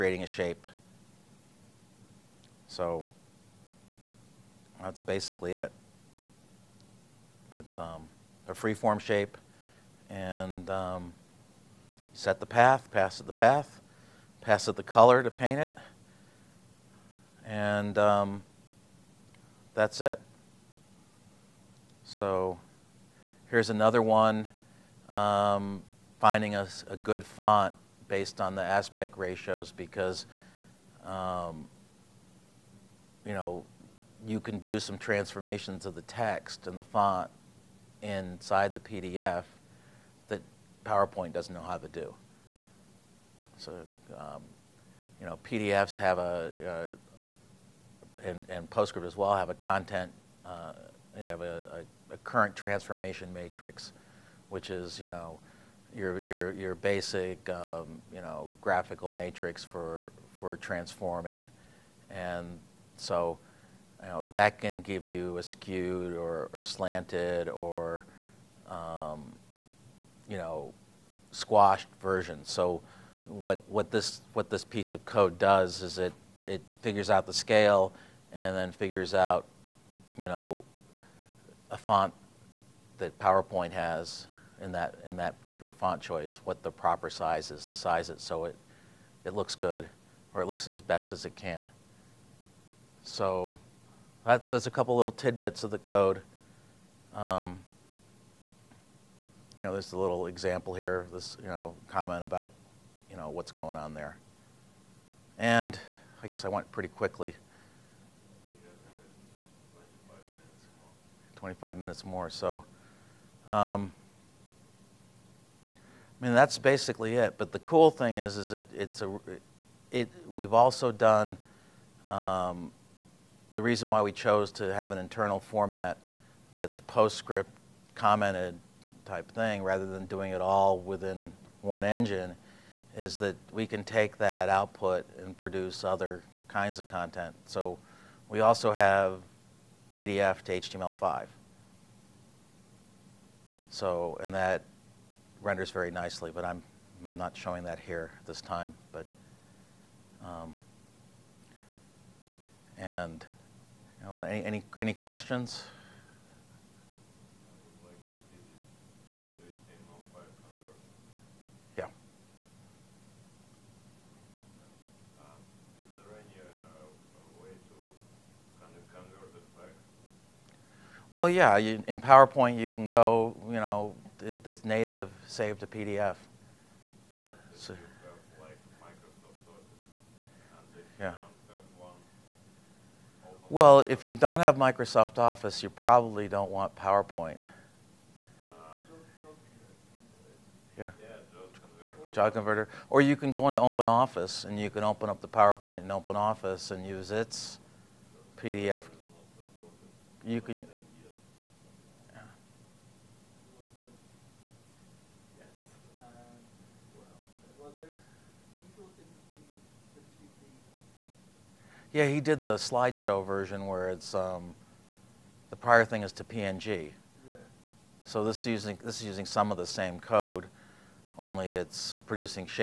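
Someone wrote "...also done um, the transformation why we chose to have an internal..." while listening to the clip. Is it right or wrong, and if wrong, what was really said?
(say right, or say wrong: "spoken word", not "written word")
wrong: "reason", not "transformation".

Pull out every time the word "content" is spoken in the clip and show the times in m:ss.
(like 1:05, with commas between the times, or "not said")
0:49, 2:16.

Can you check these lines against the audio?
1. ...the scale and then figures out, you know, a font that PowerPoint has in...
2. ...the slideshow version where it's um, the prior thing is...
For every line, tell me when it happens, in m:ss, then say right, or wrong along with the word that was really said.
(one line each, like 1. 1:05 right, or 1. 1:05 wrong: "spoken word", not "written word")
1. 1:17 right
2. 3:32 right.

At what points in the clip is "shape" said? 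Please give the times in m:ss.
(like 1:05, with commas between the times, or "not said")
0:00, 0:08.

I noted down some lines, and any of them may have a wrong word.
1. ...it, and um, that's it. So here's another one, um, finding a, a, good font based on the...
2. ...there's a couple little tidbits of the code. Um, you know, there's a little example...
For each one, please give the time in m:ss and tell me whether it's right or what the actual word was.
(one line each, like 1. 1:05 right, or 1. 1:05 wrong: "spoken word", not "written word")
1. 0:15 right
2. 1:34 right.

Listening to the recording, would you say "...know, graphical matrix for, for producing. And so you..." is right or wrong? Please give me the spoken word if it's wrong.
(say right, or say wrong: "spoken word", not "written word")
wrong: "transforming", not "producing".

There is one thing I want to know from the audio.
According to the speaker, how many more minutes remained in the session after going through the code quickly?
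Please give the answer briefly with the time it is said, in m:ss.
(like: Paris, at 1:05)
25, at 1:51.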